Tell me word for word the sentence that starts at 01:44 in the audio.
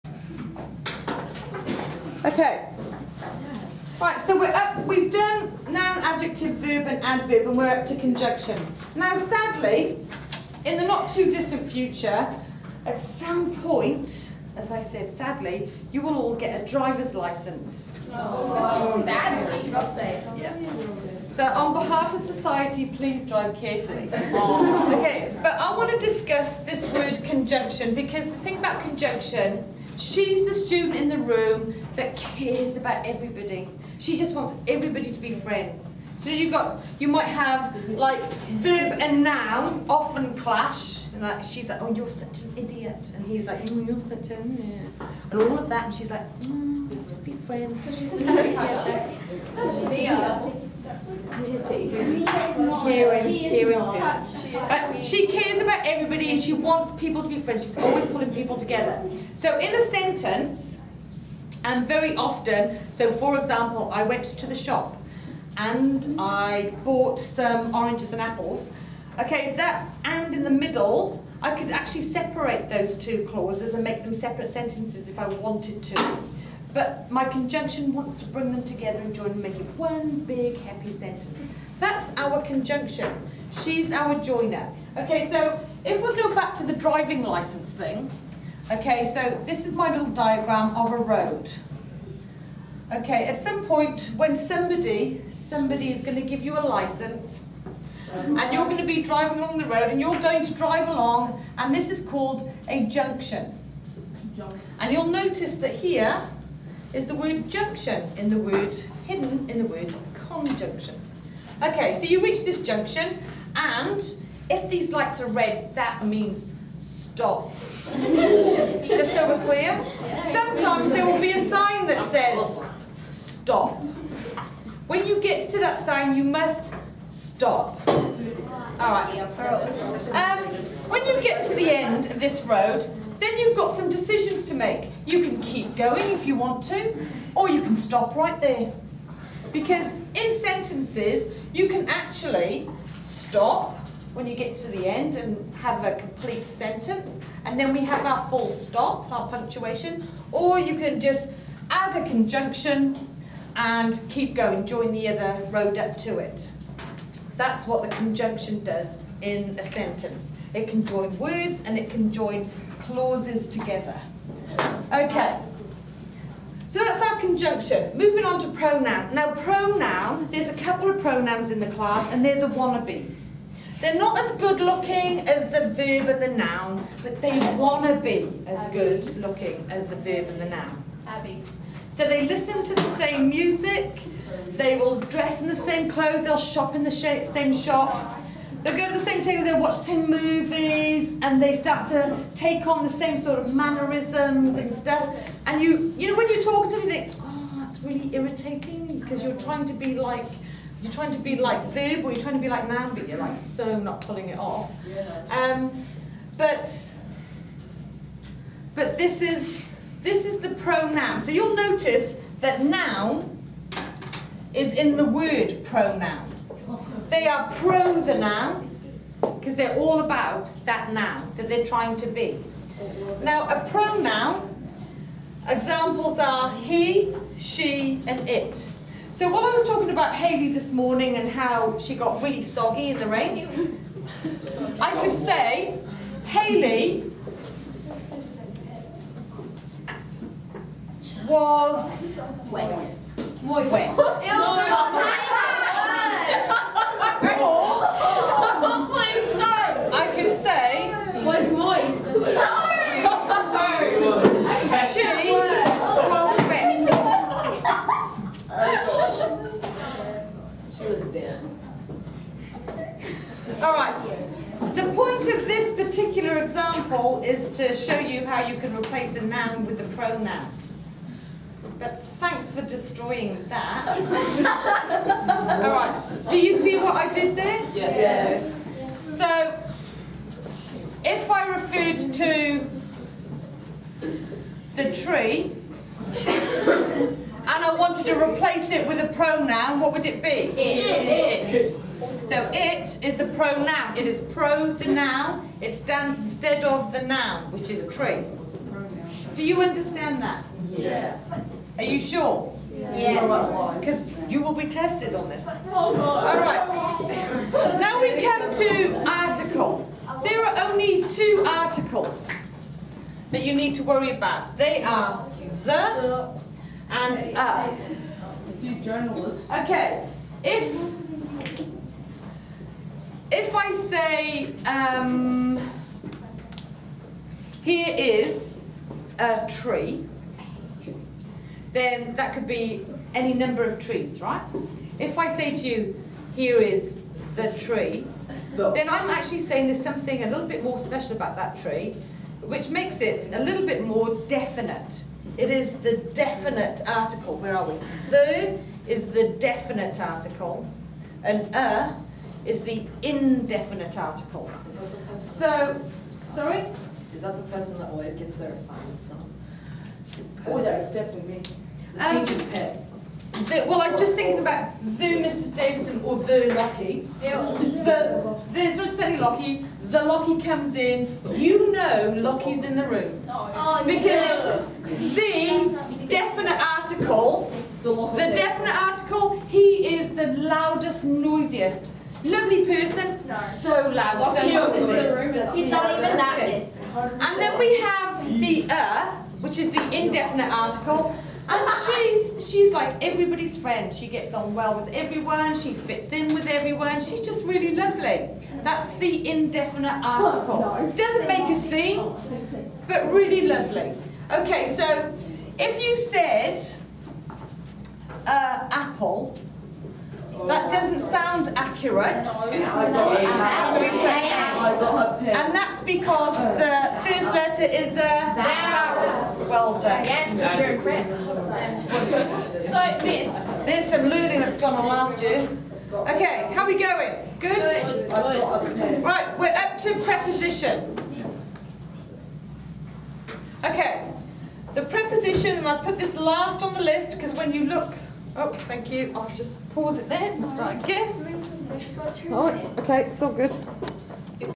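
And you'll notice that here is the word junction in the word hidden in the word conjunction.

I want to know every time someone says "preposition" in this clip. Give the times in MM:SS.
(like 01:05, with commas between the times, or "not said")
07:10, 07:14.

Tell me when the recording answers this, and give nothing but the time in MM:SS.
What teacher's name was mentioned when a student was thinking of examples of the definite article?
06:05.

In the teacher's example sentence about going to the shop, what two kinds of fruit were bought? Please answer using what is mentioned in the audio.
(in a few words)
oranges and apples.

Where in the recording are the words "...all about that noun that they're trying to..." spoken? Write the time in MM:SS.
03:39.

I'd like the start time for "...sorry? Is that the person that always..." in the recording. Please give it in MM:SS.
05:56.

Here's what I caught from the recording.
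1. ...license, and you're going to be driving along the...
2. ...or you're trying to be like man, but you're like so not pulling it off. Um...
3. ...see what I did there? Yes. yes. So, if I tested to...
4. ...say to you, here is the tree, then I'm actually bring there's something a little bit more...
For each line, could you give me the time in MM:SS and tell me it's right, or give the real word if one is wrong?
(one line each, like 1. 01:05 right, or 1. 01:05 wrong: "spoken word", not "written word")
1. 01:36 right
2. 03:22 right
3. 04:36 wrong: "referred", not "tested"
4. 05:35 wrong: "saying", not "bring".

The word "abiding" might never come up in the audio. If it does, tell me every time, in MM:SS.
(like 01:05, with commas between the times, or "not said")
not said.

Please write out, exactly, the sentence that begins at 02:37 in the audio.
That's what the conjunction does in a sentence.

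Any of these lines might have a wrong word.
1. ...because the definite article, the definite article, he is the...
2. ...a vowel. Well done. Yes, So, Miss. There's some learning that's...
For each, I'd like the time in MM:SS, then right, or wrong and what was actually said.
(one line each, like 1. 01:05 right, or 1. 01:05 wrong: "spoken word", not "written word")
1. 06:13 right
2. 06:57 right.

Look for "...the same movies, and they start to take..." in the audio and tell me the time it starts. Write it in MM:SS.
03:09.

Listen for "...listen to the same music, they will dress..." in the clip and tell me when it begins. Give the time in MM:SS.
03:02.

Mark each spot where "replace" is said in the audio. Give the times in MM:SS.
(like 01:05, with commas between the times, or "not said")
04:28, 04:48.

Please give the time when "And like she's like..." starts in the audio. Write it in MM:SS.
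00:41.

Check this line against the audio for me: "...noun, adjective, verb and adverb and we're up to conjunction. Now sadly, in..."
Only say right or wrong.
right.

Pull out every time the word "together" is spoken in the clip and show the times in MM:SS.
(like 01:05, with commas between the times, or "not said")
00:58, 01:18, 02:43.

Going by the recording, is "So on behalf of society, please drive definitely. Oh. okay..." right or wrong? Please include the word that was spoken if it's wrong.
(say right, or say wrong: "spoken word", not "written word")
wrong: "carefully", not "definitely".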